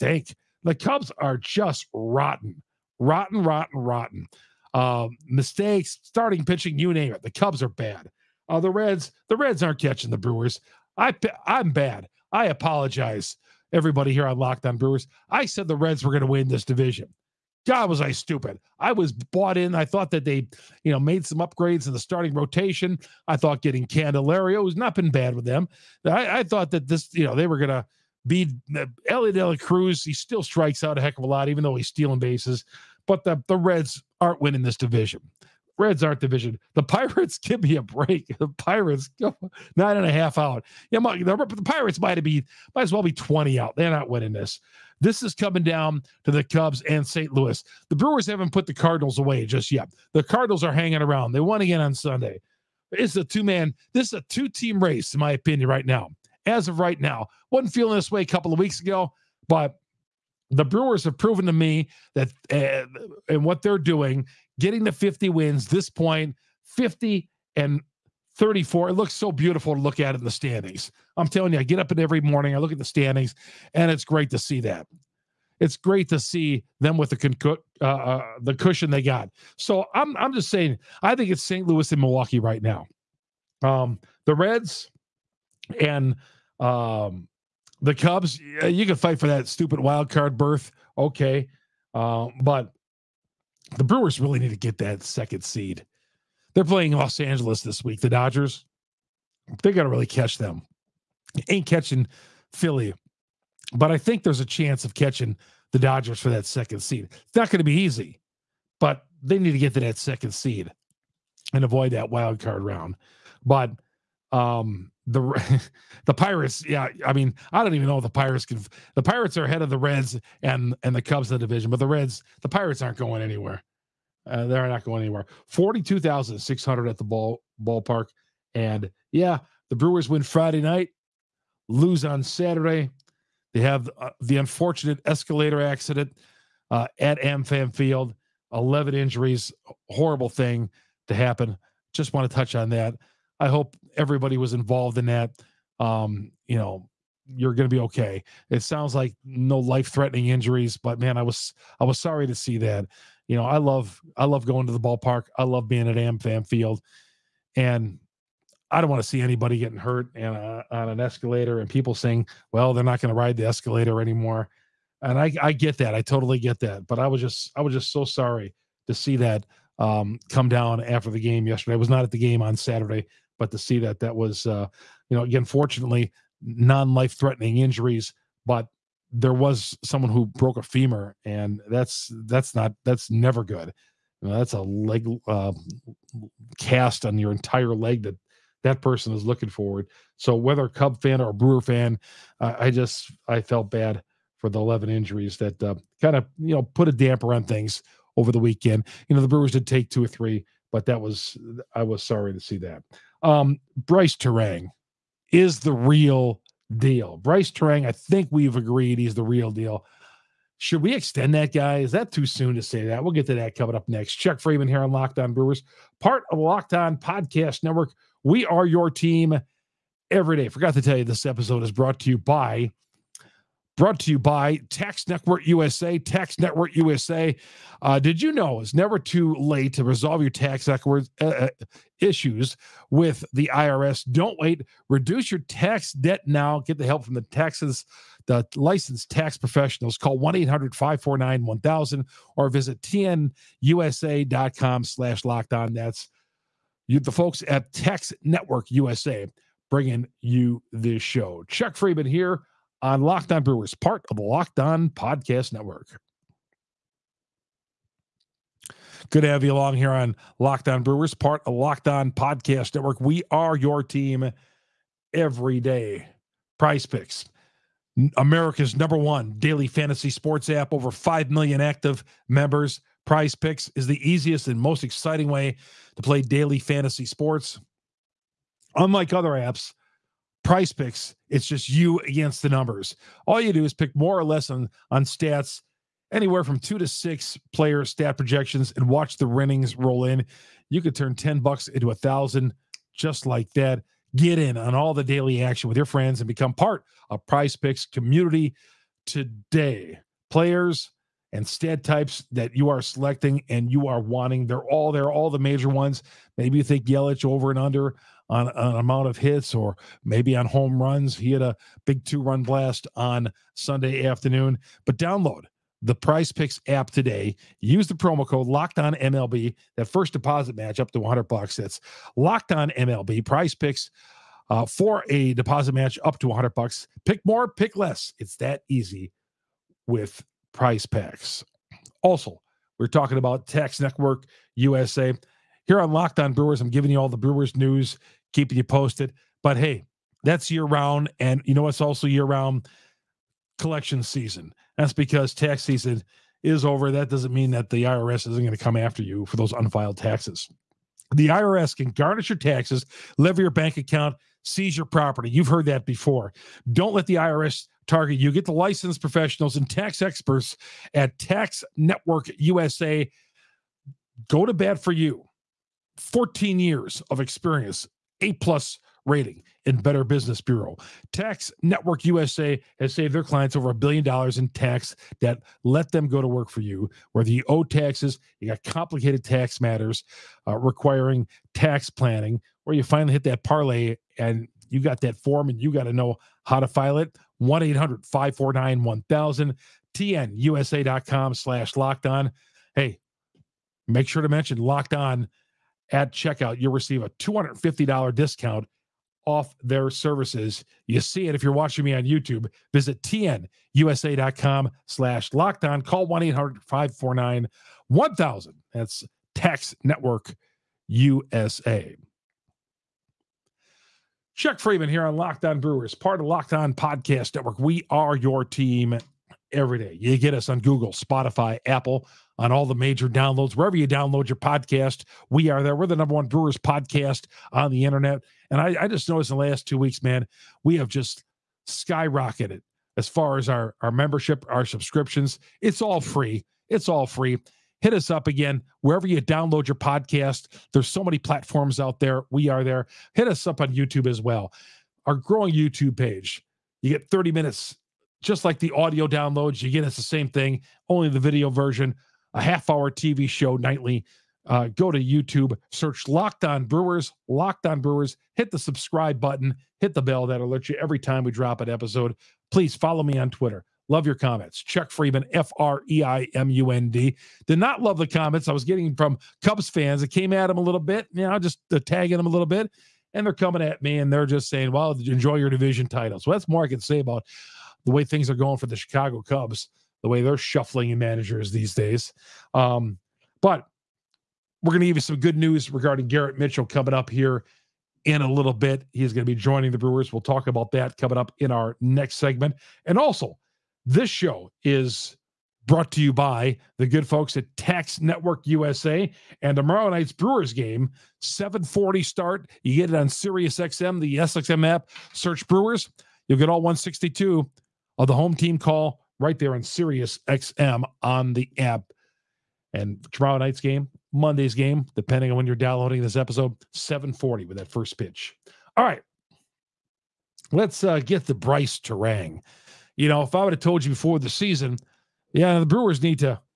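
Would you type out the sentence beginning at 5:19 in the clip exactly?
That first deposit match up to 100 bucks.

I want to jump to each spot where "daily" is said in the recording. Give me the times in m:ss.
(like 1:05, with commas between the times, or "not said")
4:29, 4:36, 4:55.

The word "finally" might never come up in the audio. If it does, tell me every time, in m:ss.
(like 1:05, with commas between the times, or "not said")
6:22.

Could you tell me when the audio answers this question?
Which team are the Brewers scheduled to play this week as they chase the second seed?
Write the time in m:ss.
1:36.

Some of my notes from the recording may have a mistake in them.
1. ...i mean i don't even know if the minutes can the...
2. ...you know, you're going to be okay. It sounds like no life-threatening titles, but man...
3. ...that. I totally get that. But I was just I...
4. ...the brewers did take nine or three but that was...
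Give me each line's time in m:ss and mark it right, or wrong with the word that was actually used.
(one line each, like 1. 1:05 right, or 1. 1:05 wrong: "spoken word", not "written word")
1. 1:57 wrong: "pirates", not "minutes"
2. 2:26 wrong: "injuries", not "titles"
3. 2:45 right
4. 3:19 wrong: "two", not "nine".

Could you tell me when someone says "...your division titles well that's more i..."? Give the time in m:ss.
7:55.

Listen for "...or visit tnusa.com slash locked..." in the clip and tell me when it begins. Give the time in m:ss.
4:02.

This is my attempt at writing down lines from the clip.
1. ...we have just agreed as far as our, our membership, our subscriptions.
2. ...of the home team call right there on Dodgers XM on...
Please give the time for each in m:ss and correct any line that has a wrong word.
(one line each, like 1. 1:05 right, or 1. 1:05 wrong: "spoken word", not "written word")
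1. 7:10 wrong: "skyrocketed", not "agreed"
2. 8:27 wrong: "Sirius", not "Dodgers".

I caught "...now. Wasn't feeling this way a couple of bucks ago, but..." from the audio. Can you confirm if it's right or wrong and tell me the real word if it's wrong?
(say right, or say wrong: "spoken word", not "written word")
wrong: "weeks", not "bucks".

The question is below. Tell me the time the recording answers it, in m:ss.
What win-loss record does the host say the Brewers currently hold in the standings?
1:06.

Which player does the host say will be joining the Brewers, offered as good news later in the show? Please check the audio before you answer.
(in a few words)
Garrett Mitchell.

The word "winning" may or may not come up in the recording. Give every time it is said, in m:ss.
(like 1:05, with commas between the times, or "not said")
0:34, 0:44, 4:49.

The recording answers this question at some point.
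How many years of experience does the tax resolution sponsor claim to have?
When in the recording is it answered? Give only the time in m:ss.
6:05.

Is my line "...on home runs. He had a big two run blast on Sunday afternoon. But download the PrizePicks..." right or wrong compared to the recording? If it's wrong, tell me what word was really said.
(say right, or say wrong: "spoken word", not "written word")
right.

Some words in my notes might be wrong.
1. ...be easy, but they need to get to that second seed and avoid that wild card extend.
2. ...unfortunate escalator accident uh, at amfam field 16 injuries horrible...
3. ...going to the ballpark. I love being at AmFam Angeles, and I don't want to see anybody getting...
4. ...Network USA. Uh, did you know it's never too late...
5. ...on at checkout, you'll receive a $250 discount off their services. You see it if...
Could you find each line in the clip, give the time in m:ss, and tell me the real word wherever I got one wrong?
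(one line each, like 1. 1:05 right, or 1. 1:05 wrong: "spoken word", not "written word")
1. 1:47 wrong: "round", not "extend"
2. 2:14 wrong: "11", not "16"
3. 2:34 wrong: "Field", not "Angeles"
4. 3:46 right
5. 6:34 right.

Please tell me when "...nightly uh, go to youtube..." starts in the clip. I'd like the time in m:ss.
7:33.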